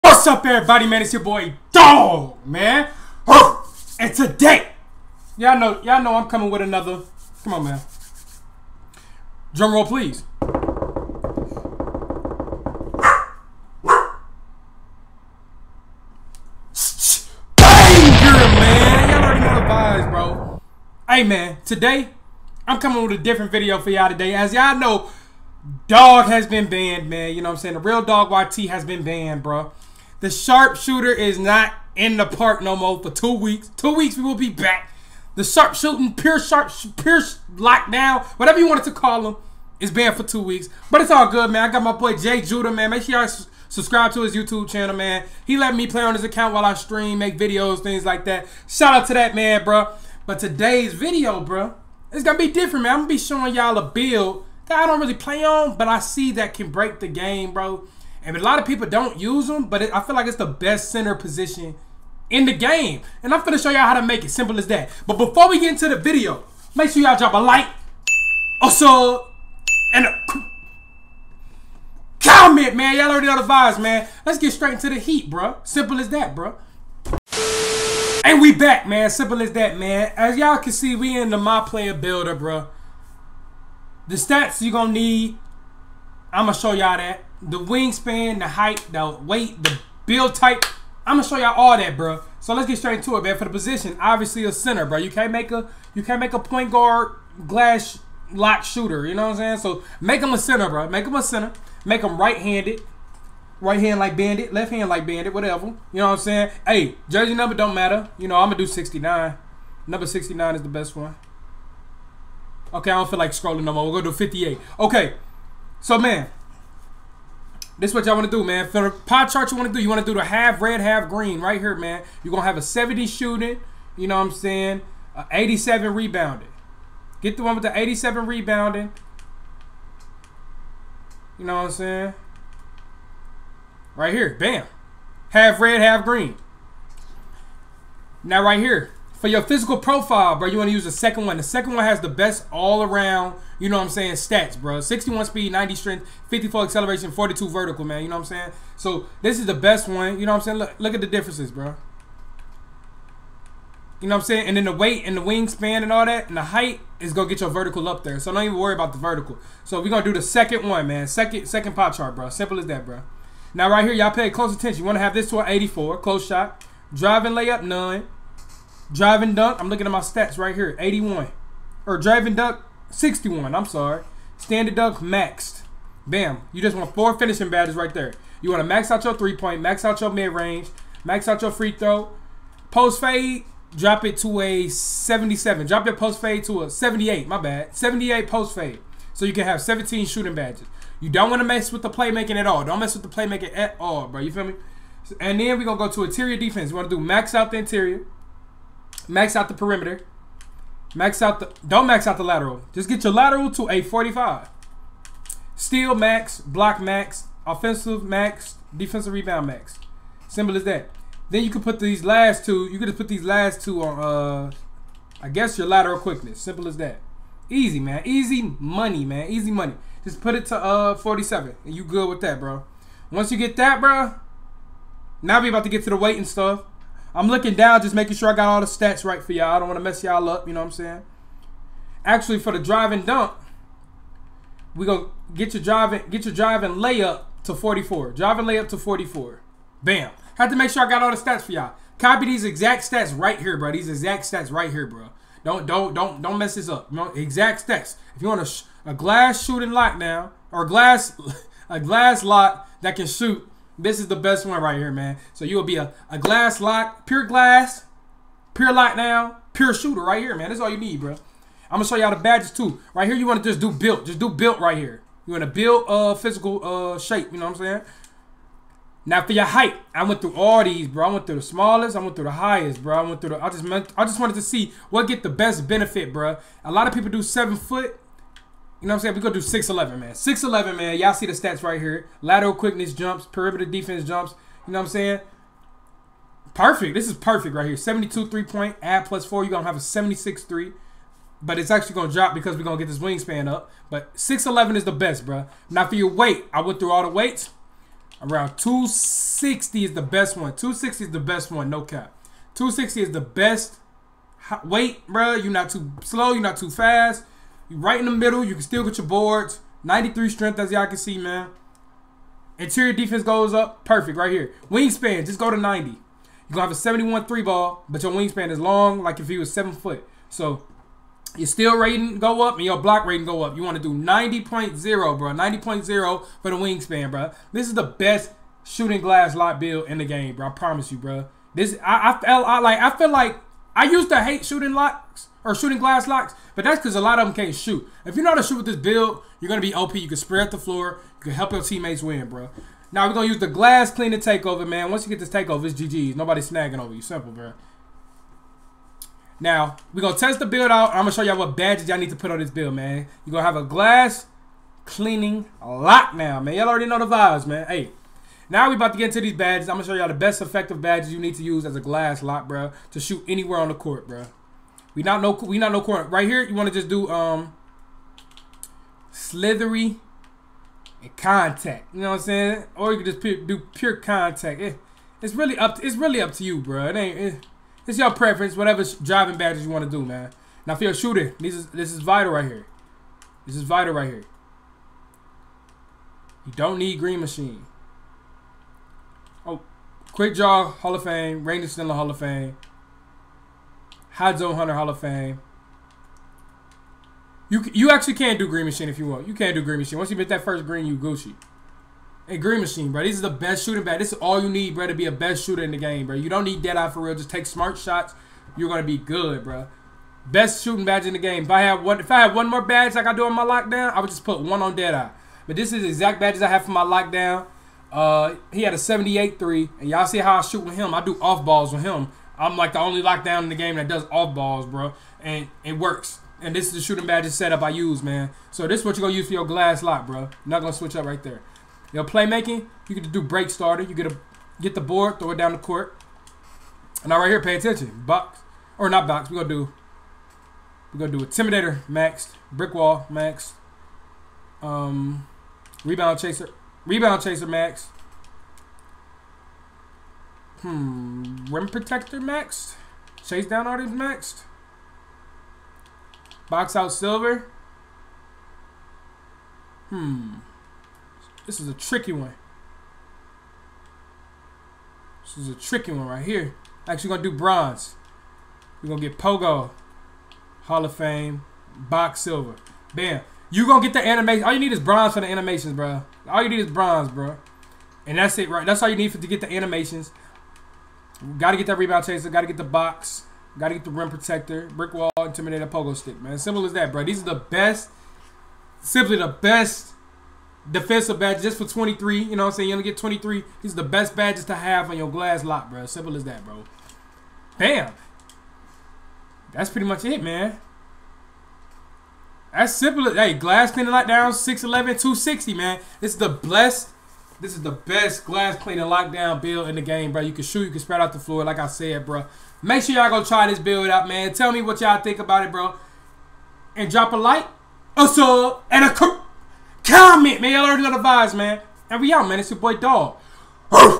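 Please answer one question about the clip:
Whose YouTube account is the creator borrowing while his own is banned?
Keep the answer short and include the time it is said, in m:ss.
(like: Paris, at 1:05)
Jay Judah, at 0:42.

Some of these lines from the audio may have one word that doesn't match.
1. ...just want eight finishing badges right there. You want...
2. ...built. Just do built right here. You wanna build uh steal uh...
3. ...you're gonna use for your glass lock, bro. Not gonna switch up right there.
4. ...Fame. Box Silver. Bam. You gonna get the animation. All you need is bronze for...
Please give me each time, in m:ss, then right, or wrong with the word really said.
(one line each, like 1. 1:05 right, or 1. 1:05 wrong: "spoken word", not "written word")
1. 2:56 wrong: "four", not "eight"
2. 4:23 wrong: "physical", not "steal"
3. 7:08 right
4. 7:50 right.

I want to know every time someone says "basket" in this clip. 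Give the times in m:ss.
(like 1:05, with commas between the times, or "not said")
not said.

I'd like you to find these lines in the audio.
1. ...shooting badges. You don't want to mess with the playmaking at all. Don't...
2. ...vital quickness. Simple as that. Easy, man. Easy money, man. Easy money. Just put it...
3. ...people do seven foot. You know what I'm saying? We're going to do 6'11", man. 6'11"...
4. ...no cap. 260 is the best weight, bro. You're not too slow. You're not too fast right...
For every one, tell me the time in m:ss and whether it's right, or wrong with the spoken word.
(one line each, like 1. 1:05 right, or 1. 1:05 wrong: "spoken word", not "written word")
1. 3:10 right
2. 3:35 wrong: "lateral", not "vital"
3. 4:36 right
4. 5:01 right.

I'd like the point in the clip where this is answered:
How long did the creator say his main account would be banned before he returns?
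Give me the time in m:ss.
0:33.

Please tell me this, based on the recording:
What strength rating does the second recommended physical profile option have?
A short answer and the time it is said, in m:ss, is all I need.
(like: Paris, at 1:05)
90, at 2:25.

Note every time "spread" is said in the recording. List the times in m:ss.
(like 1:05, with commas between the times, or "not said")
5:40, 8:30.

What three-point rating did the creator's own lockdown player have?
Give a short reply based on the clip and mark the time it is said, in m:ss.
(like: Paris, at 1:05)
78, at 6:58.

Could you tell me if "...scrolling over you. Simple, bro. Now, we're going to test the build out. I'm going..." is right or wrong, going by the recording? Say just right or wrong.
wrong.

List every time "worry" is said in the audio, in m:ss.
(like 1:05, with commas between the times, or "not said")
2:38.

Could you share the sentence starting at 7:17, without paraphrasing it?
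And now right here, pay attention.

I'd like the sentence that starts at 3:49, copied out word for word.
I don't want to mess y'all up, you know what I'm saying?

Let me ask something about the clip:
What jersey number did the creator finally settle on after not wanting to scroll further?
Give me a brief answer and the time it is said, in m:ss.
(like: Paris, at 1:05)
58, at 1:54.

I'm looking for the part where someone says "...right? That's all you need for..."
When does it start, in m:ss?
7:58.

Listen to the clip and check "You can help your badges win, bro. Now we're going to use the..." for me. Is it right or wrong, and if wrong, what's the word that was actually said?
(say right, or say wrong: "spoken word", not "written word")
wrong: "teammates", not "badges".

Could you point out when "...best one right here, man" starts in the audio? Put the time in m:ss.
4:14.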